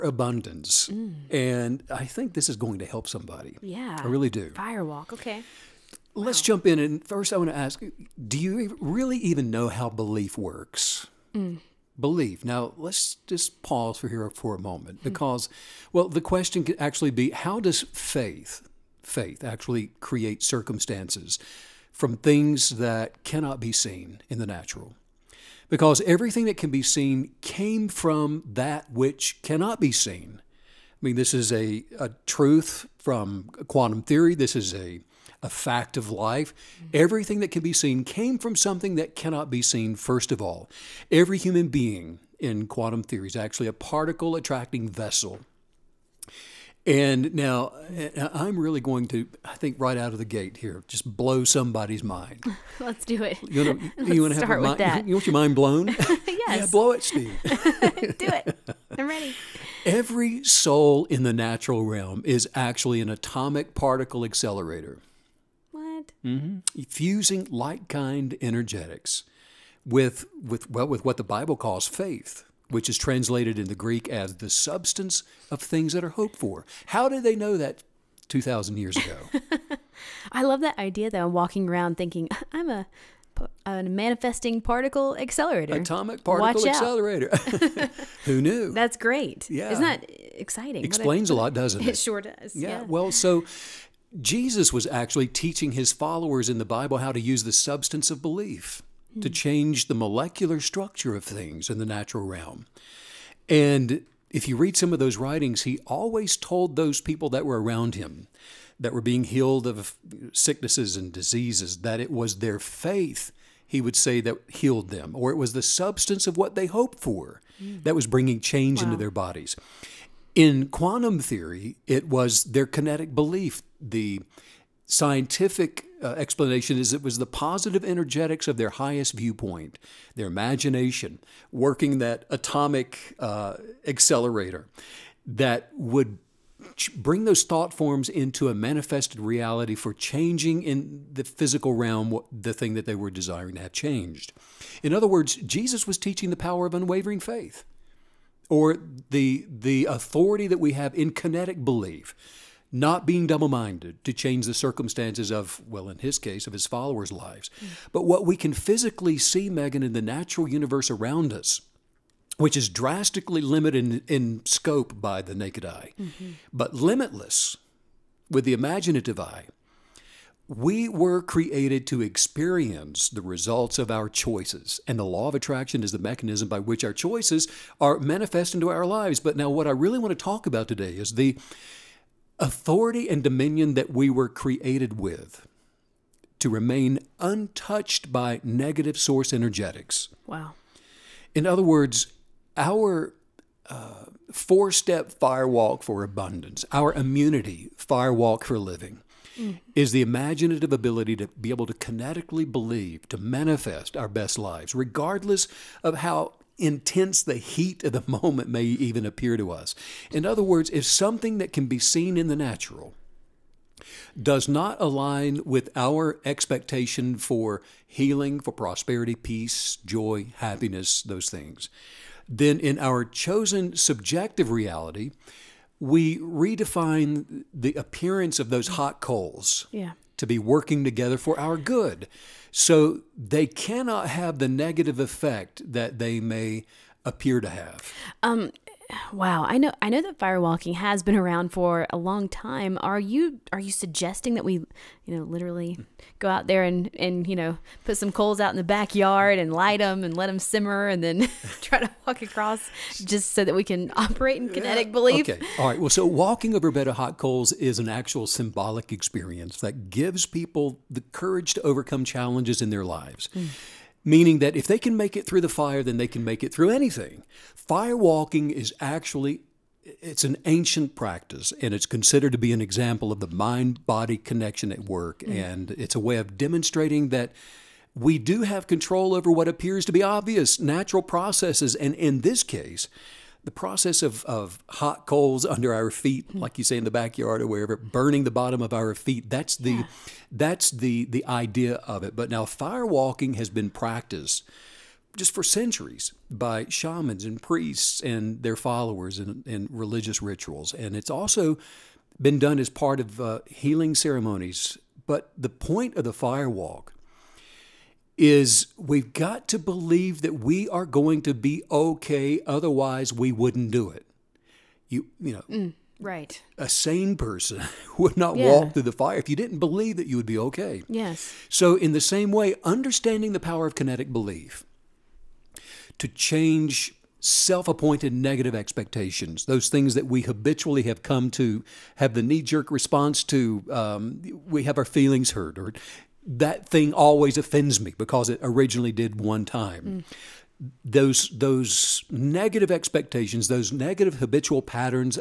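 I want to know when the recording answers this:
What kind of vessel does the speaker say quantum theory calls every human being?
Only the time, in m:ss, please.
0:43.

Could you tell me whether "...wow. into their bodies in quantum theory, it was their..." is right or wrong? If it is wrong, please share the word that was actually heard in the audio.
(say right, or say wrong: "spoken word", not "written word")
right.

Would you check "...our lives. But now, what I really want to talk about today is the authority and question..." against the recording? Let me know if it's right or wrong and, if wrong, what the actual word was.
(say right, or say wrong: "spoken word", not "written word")
wrong: "dominion", not "question".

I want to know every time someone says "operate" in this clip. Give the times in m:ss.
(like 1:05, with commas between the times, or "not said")
4:13.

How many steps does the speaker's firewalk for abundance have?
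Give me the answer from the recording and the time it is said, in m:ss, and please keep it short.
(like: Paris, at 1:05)
4, at 3:14.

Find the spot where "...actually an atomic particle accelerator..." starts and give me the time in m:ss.
1:02.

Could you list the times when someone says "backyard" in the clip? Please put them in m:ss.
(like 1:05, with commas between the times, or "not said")
4:08, 4:46.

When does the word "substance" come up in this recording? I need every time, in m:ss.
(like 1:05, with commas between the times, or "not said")
1:14, 1:37, 1:55.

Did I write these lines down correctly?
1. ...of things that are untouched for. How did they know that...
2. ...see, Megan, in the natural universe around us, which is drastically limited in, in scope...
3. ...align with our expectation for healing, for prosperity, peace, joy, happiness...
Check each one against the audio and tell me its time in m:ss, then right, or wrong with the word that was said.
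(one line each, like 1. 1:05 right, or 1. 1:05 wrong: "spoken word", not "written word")
1. 1:15 wrong: "hoped", not "untouched"
2. 2:39 right
3. 3:34 right.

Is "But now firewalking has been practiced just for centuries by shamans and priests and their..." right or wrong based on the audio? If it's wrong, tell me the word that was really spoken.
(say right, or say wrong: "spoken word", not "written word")
right.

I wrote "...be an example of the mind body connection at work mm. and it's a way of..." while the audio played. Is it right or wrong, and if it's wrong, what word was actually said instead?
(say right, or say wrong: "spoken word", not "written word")
right.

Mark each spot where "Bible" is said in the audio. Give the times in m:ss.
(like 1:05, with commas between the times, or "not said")
1:11, 1:36.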